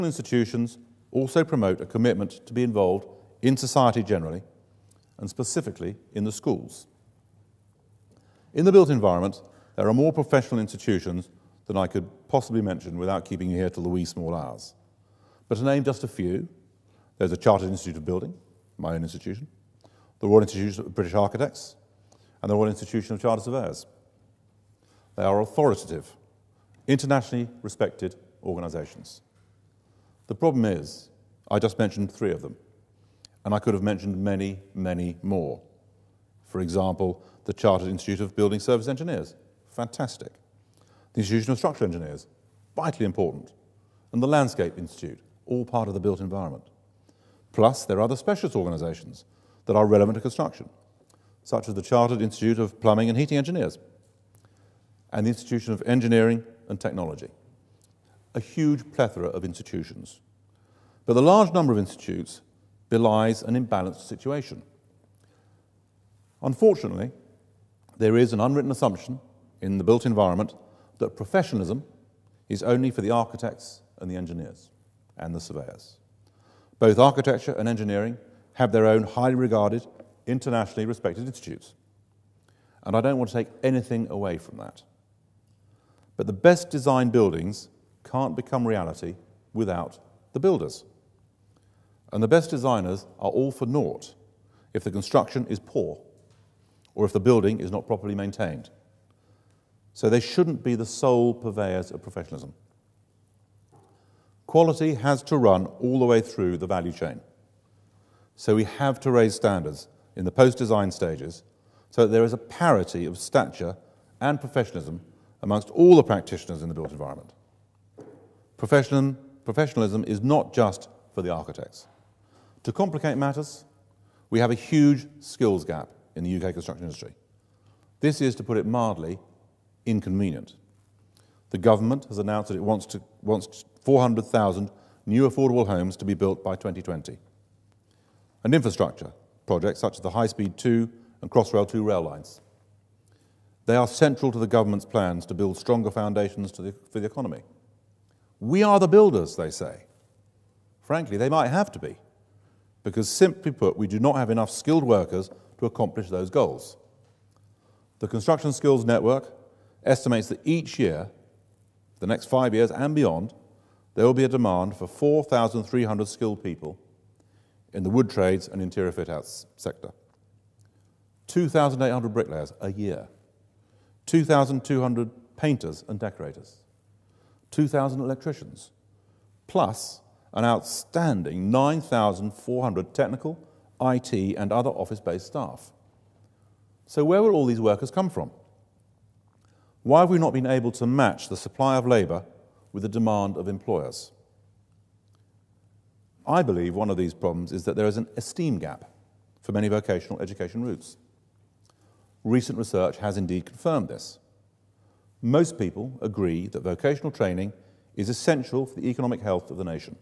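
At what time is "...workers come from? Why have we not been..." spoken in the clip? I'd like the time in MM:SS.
03:07.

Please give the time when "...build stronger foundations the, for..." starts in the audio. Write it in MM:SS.
02:25.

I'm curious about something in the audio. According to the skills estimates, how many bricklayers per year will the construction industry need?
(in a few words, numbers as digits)
2,800.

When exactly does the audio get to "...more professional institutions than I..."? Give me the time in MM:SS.
00:09.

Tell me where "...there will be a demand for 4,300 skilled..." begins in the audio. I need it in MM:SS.
02:43.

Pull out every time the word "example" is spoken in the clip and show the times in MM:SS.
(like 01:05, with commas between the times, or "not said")
00:36.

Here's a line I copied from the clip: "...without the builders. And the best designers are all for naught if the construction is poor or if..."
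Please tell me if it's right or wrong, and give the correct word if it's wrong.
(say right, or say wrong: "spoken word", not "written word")
right.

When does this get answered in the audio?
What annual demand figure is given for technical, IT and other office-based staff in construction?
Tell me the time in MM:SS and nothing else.
03:01.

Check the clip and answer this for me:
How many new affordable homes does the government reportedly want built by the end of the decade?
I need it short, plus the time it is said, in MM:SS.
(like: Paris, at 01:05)
400,000, at 02:13.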